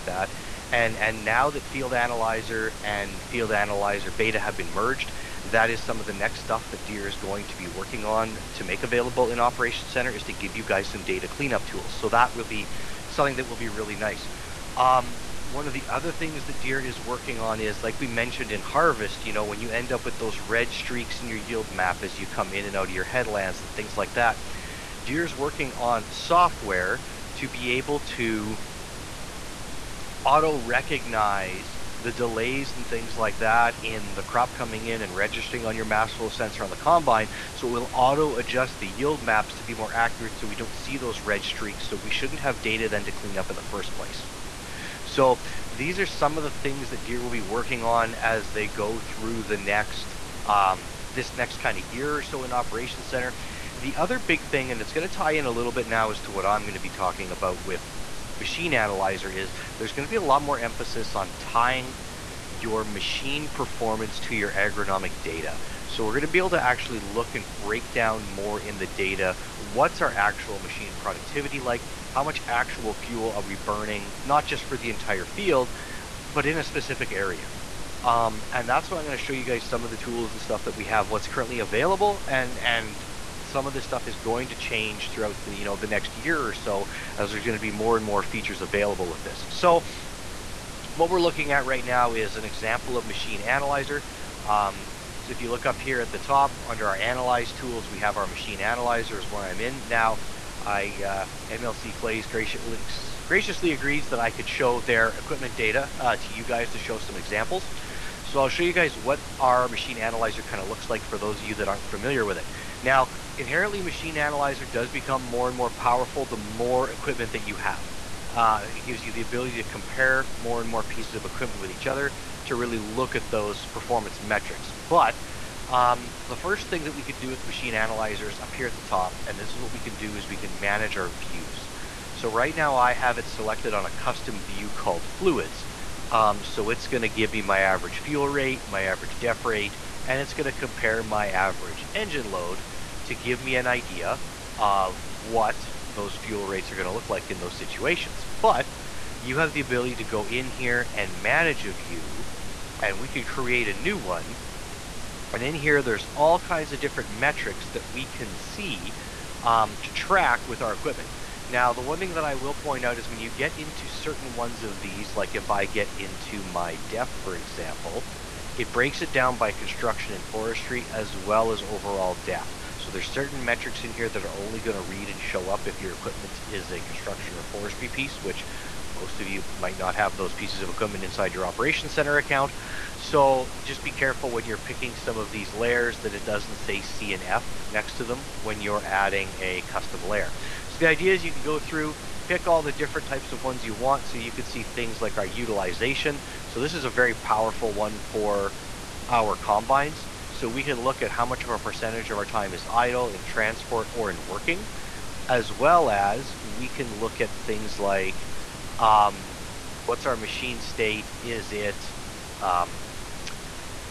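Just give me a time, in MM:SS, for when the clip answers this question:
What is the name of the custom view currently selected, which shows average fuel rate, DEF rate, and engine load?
02:15.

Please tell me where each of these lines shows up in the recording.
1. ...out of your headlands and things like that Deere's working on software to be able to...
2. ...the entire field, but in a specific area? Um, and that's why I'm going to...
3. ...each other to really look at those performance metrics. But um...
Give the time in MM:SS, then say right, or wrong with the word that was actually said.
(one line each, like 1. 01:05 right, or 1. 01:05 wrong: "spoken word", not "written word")
1. 00:22 right
2. 01:14 right
3. 02:01 right.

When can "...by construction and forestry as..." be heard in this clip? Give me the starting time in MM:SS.
02:49.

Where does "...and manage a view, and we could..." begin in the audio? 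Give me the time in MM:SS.
02:30.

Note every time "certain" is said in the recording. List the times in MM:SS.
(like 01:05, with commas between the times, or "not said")
02:43, 02:53.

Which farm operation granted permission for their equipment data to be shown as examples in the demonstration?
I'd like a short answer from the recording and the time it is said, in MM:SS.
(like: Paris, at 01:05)
MLC Clays, at 01:41.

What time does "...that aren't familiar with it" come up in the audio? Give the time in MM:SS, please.
01:51.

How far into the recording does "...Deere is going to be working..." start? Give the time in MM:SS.
00:06.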